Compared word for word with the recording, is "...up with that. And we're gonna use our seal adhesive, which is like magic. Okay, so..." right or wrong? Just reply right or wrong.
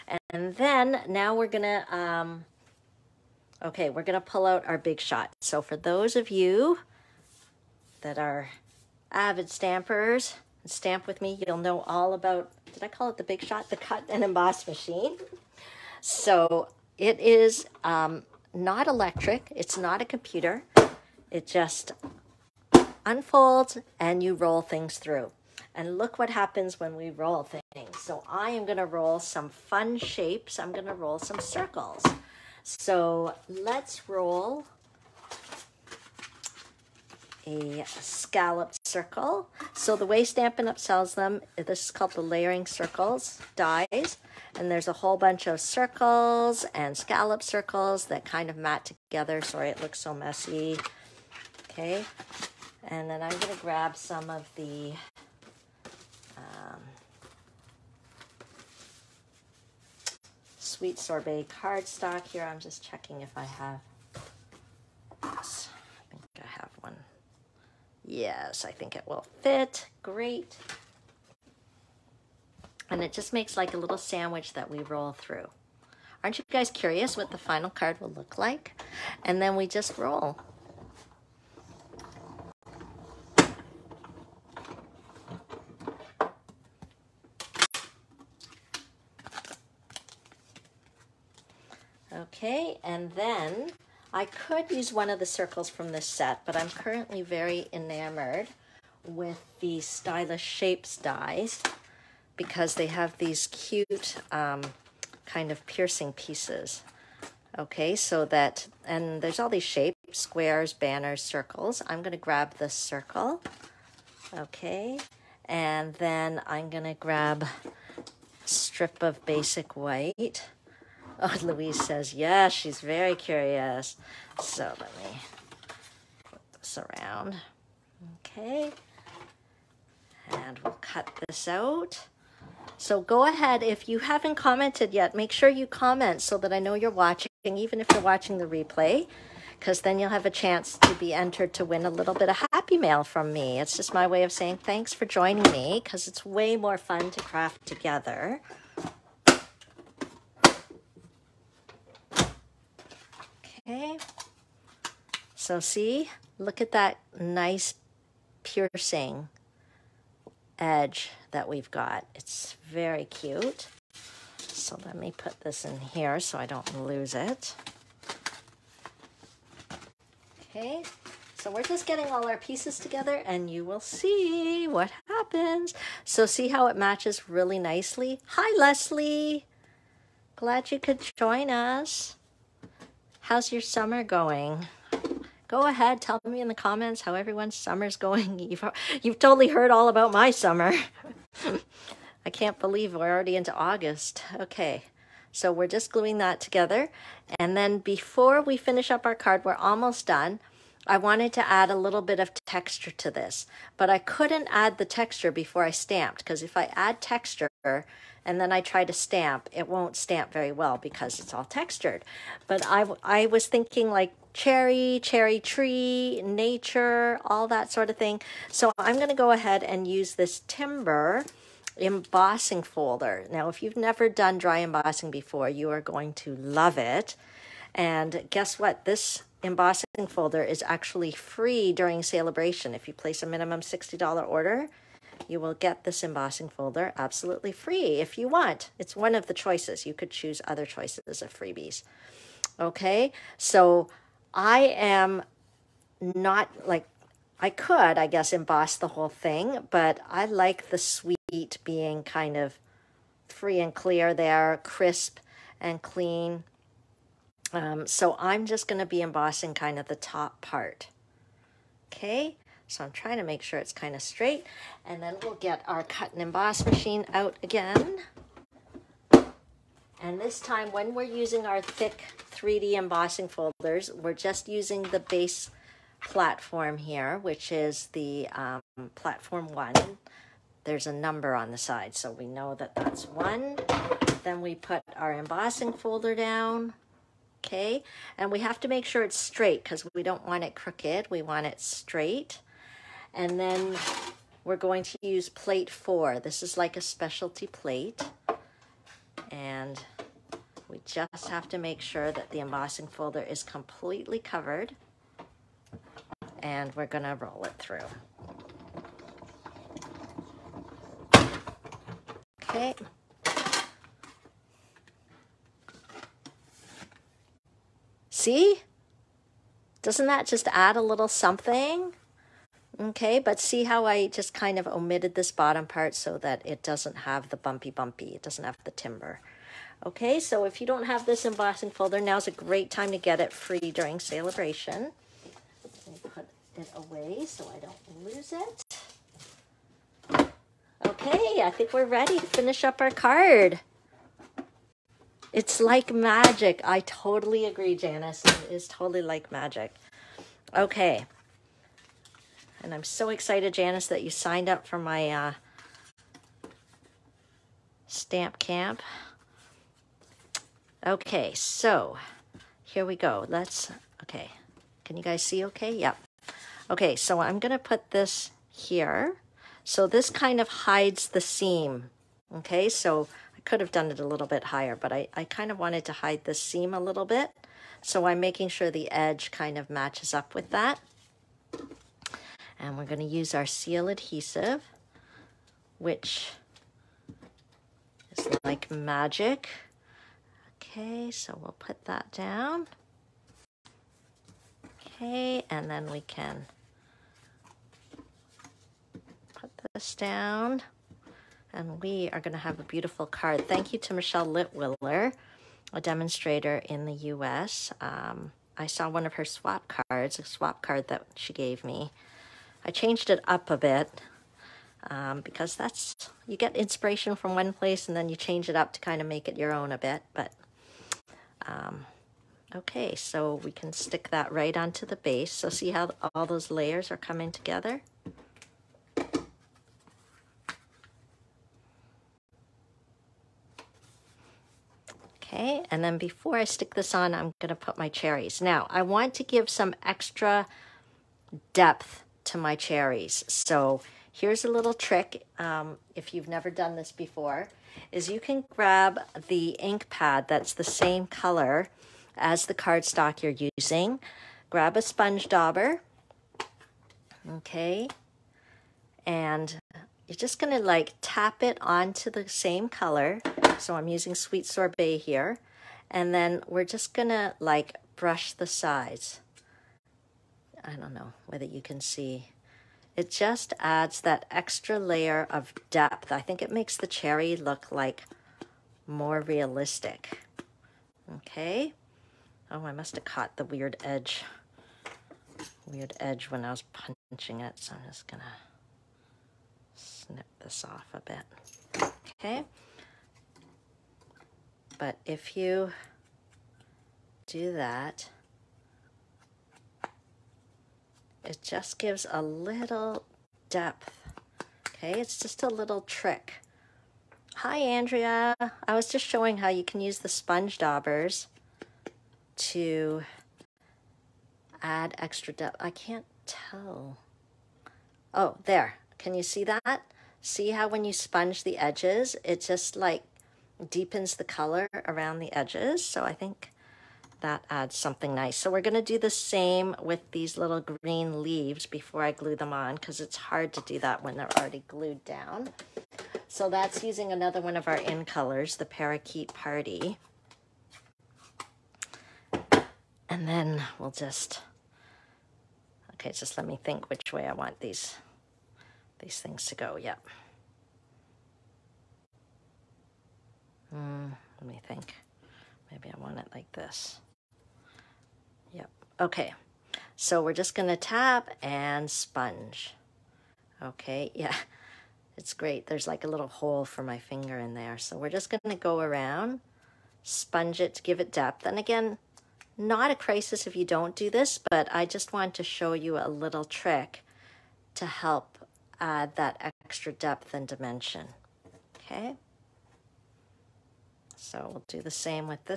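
right.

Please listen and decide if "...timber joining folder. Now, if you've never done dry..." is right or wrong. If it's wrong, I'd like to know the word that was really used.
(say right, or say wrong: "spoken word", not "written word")
wrong: "embossing", not "joining".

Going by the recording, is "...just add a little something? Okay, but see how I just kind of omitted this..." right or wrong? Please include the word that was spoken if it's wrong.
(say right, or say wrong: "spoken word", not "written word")
right.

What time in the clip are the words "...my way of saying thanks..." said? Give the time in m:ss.
2:23.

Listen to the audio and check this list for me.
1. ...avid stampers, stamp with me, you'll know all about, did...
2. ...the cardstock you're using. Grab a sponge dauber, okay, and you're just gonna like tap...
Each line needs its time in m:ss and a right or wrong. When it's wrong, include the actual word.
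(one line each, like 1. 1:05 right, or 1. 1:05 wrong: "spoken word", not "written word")
1. 0:09 right
2. 7:32 right.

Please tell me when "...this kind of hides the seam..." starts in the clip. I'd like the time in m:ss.
6:09.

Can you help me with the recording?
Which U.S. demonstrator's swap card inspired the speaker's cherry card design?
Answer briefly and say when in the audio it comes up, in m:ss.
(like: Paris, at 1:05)
Michelle Litwiller, at 6:43.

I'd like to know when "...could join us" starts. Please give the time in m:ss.
3:00.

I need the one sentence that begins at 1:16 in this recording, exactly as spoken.
Aren't you guys curious what the final card will look like?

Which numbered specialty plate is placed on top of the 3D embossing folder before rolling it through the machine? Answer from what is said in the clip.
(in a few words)
Plate 4.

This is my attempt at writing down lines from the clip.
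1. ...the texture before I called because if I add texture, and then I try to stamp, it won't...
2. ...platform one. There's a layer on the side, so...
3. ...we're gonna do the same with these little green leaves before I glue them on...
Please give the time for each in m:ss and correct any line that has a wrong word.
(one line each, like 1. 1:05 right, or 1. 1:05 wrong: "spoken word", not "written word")
1. 3:24 wrong: "stamped", not "called"
2. 4:38 wrong: "number", not "layer"
3. 8:48 right.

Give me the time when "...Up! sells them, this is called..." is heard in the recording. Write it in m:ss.
0:40.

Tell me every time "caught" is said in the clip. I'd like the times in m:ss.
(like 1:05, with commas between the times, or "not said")
8:03.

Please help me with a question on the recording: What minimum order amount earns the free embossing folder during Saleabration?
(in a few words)
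$60.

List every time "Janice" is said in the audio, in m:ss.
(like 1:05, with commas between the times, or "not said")
5:47, 5:53.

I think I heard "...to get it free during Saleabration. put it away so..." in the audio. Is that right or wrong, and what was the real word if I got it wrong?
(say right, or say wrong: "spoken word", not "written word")
right.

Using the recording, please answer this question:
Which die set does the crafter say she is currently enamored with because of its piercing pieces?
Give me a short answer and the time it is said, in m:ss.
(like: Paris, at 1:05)
Stylish Shapes, at 1:39.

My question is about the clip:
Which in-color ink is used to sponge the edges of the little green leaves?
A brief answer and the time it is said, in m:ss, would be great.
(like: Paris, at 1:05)
Parakeet Party, at 8:58.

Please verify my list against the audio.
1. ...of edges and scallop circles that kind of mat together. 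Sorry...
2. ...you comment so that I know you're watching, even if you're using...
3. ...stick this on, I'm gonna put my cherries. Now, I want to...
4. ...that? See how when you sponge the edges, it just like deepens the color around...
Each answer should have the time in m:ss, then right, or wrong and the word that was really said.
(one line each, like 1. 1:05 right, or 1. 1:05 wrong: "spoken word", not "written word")
1. 0:45 wrong: "circles", not "edges"
2. 2:15 wrong: "watching", not "using"
3. 7:16 right
4. 8:39 right.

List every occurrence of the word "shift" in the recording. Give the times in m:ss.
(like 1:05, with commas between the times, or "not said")
not said.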